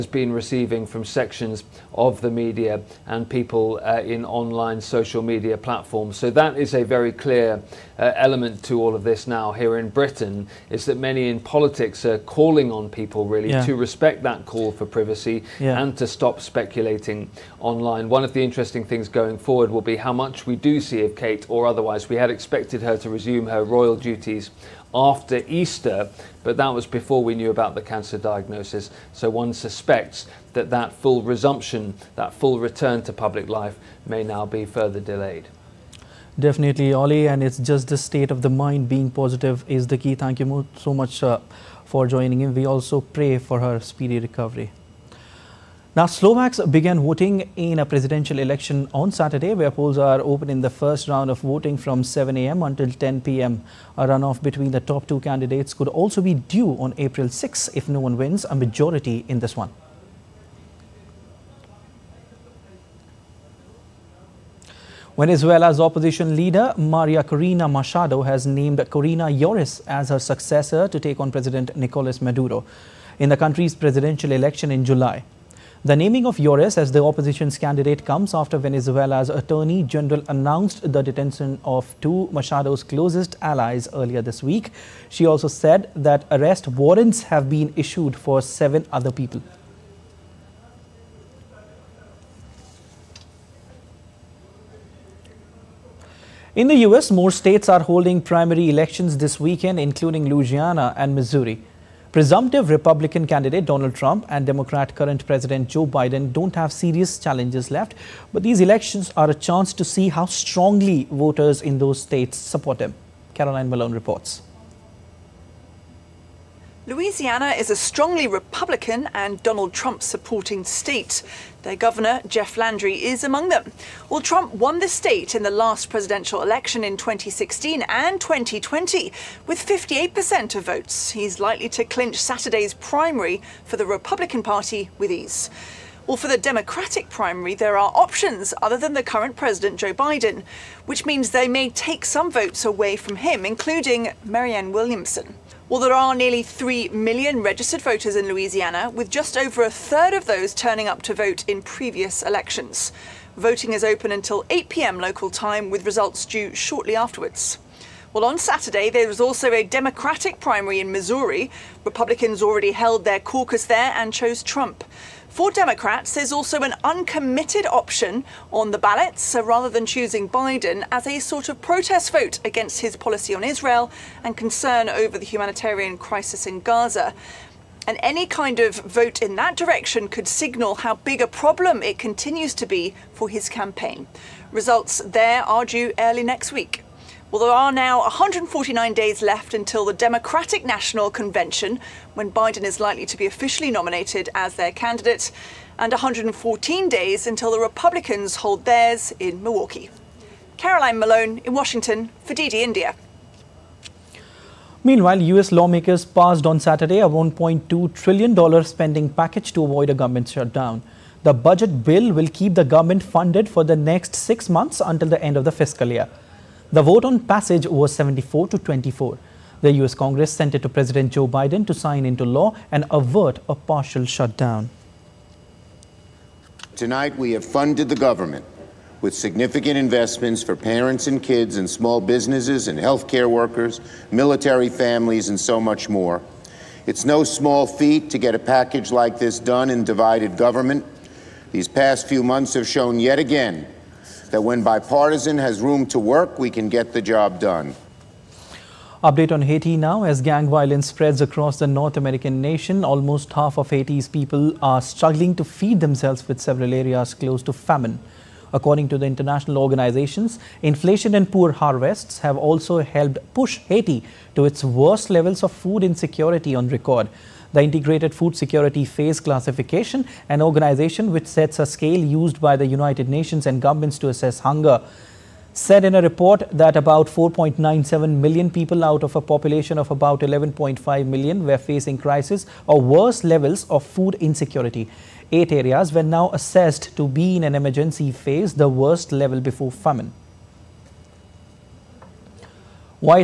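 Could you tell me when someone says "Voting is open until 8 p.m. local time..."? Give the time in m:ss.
2:33.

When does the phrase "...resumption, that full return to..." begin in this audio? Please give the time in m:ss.
0:31.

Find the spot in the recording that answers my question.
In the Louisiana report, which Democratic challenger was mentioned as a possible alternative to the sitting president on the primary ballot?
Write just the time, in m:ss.
2:24.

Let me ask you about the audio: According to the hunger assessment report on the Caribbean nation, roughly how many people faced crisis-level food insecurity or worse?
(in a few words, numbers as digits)
4.97 million.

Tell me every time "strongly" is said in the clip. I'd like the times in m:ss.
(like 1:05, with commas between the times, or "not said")
1:50, 1:57.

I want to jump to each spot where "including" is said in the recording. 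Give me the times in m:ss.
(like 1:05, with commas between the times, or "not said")
1:39, 2:23.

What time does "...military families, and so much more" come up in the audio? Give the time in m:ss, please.
3:54.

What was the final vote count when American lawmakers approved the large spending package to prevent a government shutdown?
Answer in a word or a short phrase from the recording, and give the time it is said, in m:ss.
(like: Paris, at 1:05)
74 to 24, at 3:37.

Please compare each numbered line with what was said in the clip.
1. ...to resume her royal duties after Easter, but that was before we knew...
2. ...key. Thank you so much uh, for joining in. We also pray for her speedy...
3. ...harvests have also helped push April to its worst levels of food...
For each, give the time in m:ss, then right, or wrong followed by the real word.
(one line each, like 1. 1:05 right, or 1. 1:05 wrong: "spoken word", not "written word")
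1. 0:22 right
2. 0:39 right
3. 4:21 wrong: "Haiti", not "April".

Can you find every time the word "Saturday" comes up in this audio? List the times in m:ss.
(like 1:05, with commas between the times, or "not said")
0:49, 2:12, 2:38, 3:26.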